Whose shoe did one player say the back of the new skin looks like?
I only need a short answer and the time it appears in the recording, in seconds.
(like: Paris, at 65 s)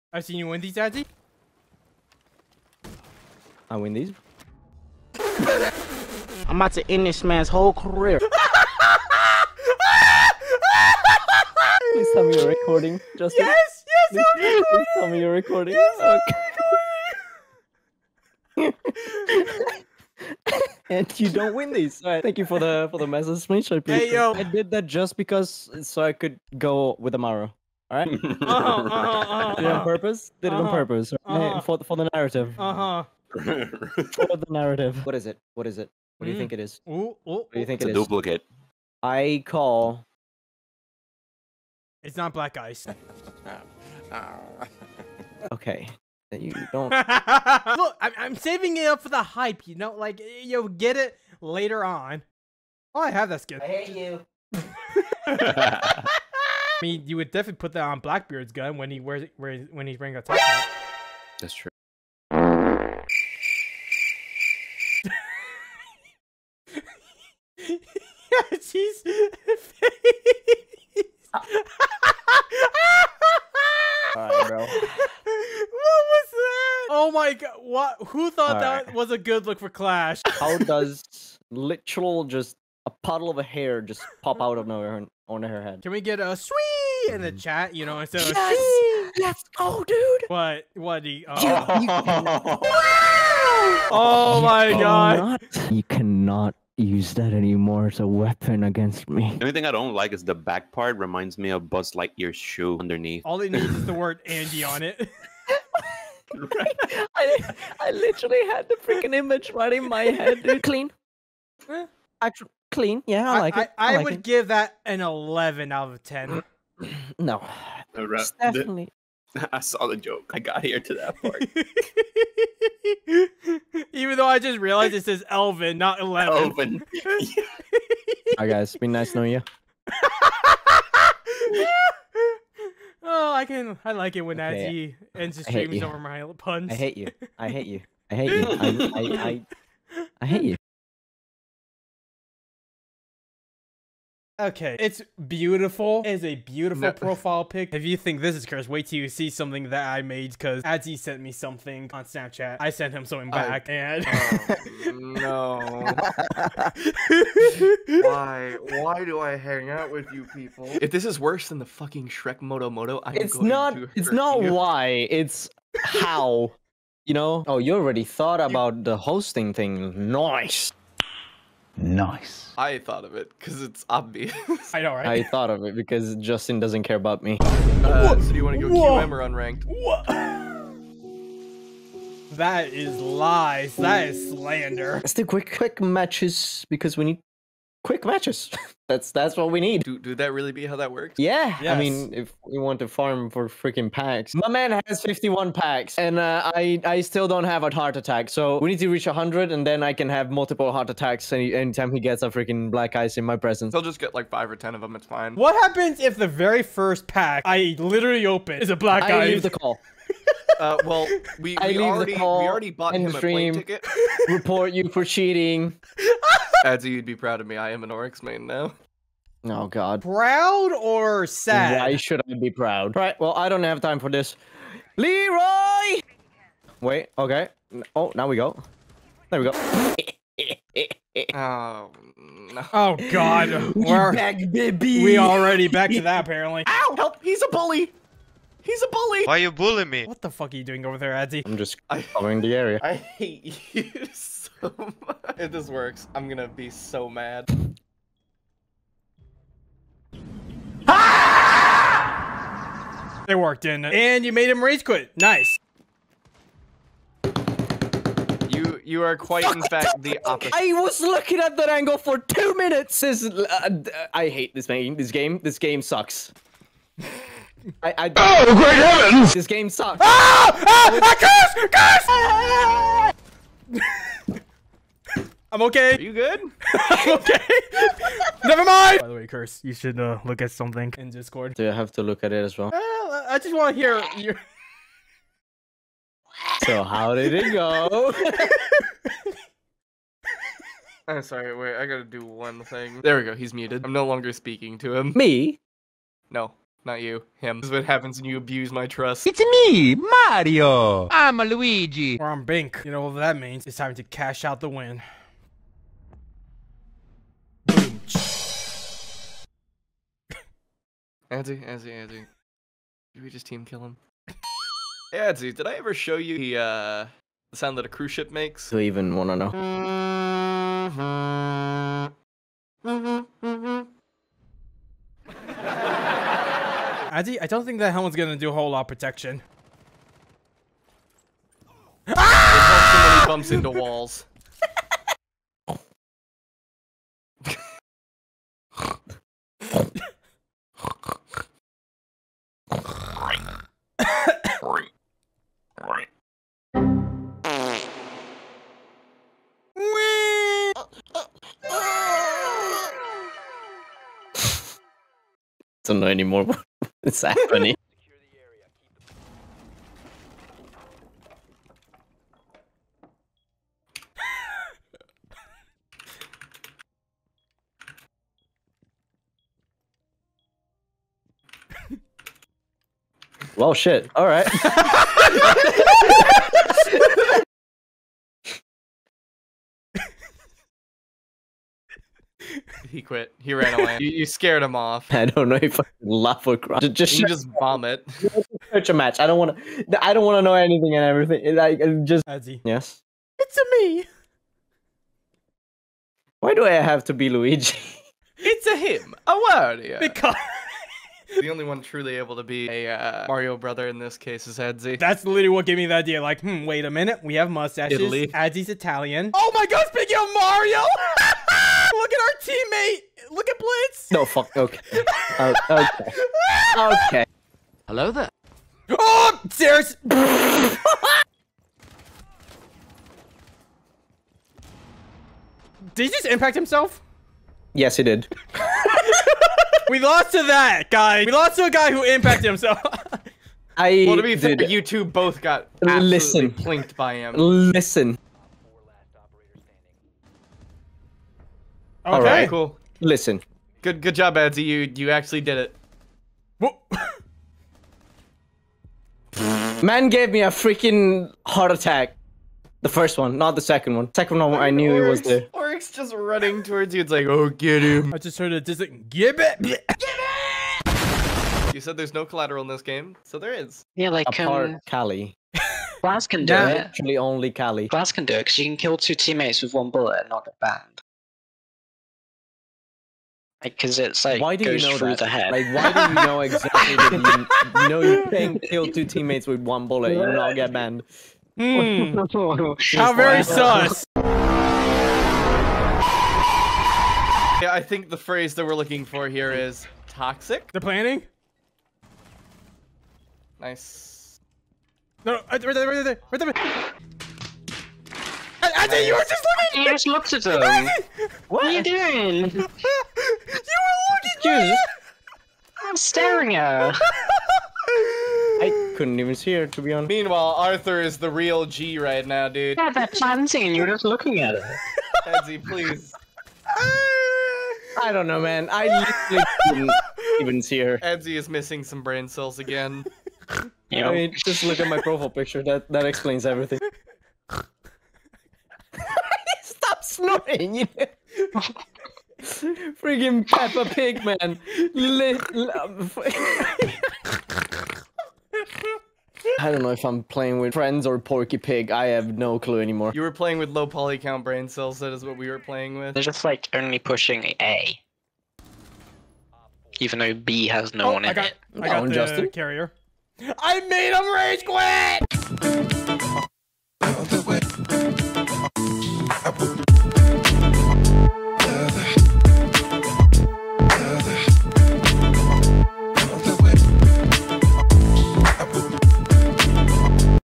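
Buzz Lightyear, at 101 s.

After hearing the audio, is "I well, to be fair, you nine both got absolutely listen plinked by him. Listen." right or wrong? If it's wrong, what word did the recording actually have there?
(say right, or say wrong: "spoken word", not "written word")
wrong: "two", not "nine".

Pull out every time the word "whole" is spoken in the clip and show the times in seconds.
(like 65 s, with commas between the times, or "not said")
7 s, 328 s.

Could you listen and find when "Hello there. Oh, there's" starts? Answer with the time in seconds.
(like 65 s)
417 s.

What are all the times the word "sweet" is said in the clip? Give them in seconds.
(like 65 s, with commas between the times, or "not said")
86 s.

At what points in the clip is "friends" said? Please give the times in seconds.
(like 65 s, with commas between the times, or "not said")
540 s.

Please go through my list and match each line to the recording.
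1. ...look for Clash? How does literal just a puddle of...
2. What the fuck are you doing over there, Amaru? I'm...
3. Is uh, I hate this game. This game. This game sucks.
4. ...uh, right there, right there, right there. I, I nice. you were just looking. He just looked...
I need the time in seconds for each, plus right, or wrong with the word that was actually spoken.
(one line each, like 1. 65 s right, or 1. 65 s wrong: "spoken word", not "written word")
1. 79 s right
2. 240 s wrong: "Adzi", not "Amaru"
3. 263 s right
4. 495 s right.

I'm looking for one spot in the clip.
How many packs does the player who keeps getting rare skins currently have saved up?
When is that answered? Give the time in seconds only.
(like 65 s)
195 s.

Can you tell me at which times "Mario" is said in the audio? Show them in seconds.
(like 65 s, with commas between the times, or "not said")
299 s, 403 s, 410 s.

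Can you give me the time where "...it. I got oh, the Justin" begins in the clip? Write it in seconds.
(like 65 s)
551 s.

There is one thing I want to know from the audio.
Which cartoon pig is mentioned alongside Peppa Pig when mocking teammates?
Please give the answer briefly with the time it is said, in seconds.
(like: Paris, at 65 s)
Porky Pig, at 541 s.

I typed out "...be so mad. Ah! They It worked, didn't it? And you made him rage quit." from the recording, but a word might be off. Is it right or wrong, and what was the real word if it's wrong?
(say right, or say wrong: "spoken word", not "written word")
right.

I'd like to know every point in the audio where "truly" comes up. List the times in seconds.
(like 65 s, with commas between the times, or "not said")
401 s.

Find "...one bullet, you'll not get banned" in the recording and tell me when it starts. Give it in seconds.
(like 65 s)
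479 s.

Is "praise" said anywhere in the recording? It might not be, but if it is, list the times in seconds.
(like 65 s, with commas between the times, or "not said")
not said.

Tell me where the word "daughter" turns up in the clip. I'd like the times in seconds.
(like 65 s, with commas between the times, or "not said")
not said.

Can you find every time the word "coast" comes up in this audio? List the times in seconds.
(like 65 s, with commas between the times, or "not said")
not said.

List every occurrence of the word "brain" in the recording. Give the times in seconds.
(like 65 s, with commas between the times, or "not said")
522 s, 544 s.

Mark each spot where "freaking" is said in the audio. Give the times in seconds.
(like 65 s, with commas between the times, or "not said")
108 s, 193 s, 202 s, 450 s, 532 s.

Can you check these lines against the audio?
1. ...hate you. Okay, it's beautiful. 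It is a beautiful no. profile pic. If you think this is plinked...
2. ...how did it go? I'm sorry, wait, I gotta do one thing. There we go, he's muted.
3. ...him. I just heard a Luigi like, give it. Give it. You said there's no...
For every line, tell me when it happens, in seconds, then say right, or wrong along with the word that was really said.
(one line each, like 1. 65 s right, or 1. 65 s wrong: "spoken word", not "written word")
1. 140 s wrong: "cursed", not "plinked"
2. 286 s right
3. 457 s wrong: "Just", not "Luigi".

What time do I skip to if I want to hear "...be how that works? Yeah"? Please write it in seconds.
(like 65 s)
190 s.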